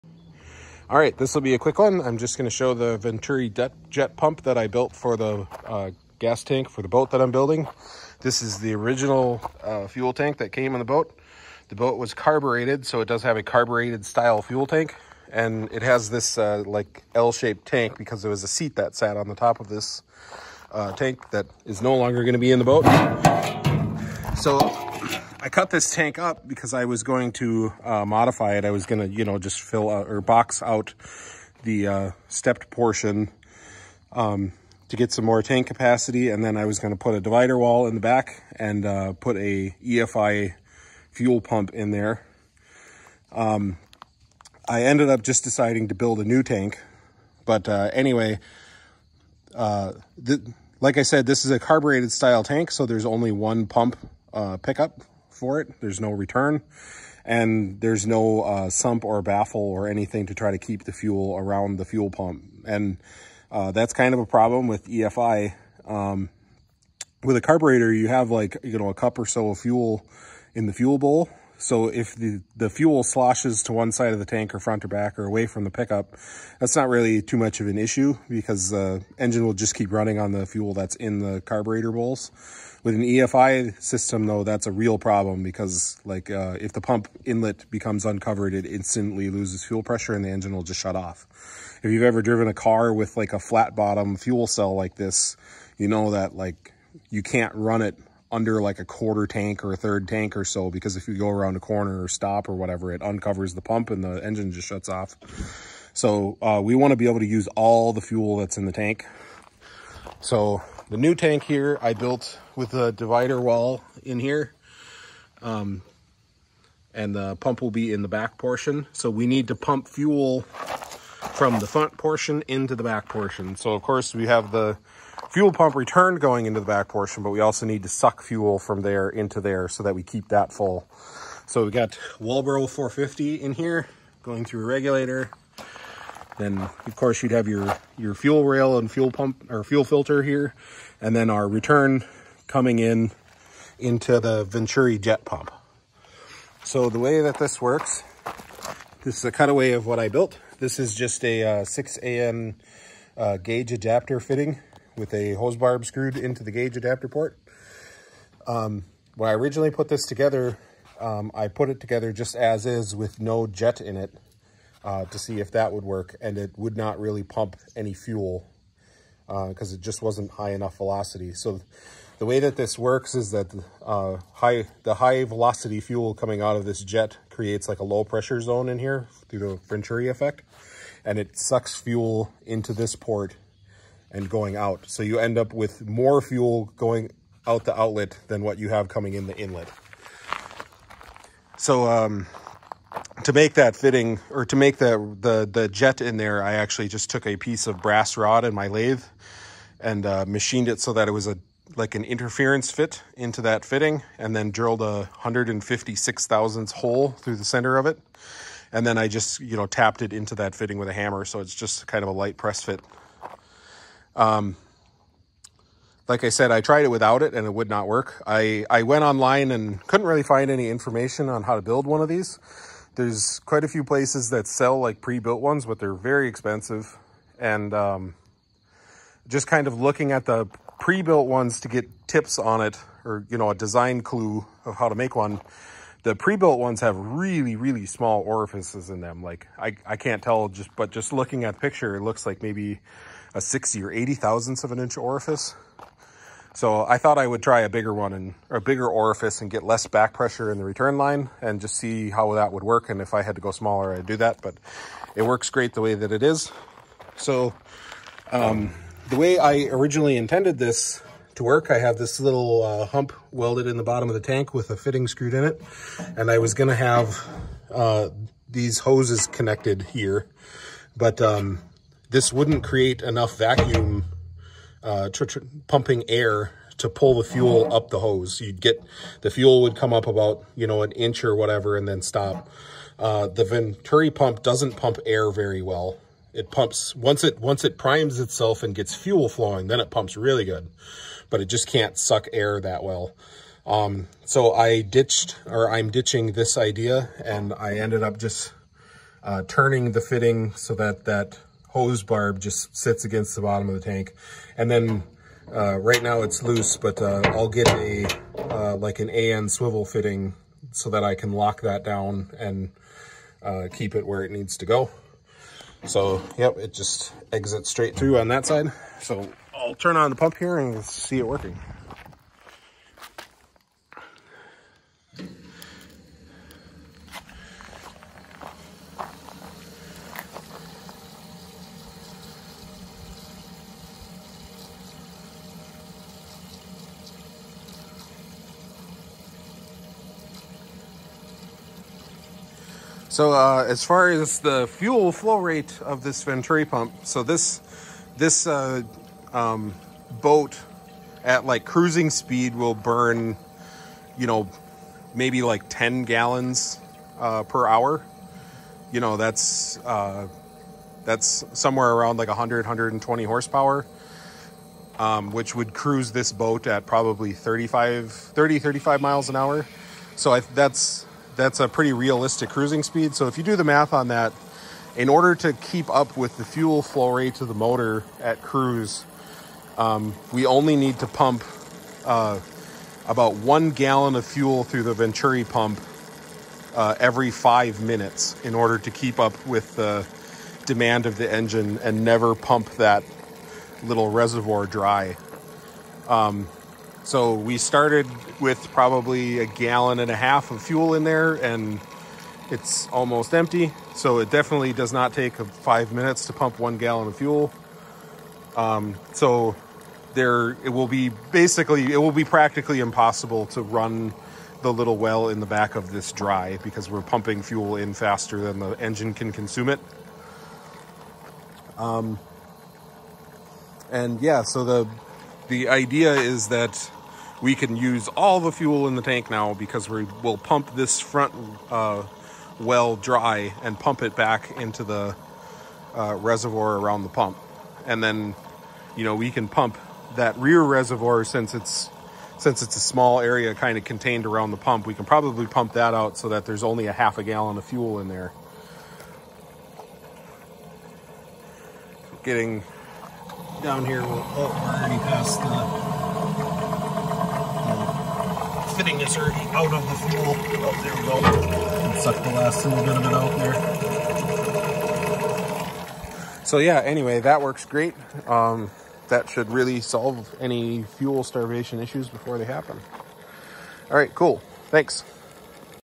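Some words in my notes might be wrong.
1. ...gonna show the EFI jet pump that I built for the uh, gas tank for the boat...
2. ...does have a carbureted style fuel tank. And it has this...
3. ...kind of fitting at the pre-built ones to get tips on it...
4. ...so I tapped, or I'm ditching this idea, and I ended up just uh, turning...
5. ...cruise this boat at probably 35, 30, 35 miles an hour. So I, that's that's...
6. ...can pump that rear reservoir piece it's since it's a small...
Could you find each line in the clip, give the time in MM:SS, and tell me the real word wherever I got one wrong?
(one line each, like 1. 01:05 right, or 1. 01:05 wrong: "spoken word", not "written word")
1. 00:02 wrong: "Venturi", not "EFI"
2. 00:13 right
3. 03:49 wrong: "looking", not "fitting"
4. 04:54 wrong: "ditched", not "tapped"
5. 06:05 right
6. 07:19 wrong: "since", not "piece".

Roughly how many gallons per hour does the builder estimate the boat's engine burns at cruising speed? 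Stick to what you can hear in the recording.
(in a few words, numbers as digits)
10 gallons.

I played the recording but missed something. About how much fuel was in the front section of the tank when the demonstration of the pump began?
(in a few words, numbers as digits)
a gallon and a half.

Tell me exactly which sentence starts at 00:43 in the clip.
Um, I ended up just deciding to build a new tank.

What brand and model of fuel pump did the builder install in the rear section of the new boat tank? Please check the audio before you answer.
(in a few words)
Walbro 450.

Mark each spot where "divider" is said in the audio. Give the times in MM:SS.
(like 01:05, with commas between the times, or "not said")
00:37, 01:52.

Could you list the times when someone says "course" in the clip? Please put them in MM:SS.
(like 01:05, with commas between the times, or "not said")
02:03, 02:16.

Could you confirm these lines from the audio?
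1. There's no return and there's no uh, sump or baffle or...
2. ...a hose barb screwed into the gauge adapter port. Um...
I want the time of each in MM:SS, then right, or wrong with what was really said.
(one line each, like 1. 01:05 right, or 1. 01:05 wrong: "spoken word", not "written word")
1. 00:55 right
2. 02:35 right.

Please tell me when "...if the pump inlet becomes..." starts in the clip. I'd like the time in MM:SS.
01:26.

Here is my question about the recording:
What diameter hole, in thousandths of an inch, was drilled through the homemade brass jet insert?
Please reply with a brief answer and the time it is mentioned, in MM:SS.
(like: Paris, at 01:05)
156 thousandths, at 03:25.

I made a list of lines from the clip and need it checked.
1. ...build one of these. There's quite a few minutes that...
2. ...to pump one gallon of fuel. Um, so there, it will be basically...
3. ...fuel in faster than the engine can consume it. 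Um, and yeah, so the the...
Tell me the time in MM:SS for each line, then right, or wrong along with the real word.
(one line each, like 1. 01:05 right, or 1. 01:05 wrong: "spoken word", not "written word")
1. 03:41 wrong: "places", not "minutes"
2. 06:46 right
3. 06:57 right.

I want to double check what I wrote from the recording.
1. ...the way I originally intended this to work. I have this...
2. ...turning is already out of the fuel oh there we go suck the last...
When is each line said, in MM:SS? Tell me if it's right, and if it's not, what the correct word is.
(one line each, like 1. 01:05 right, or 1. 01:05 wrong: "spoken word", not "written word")
1. 04:19 right
2. 07:38 wrong: "fitting", not "turning".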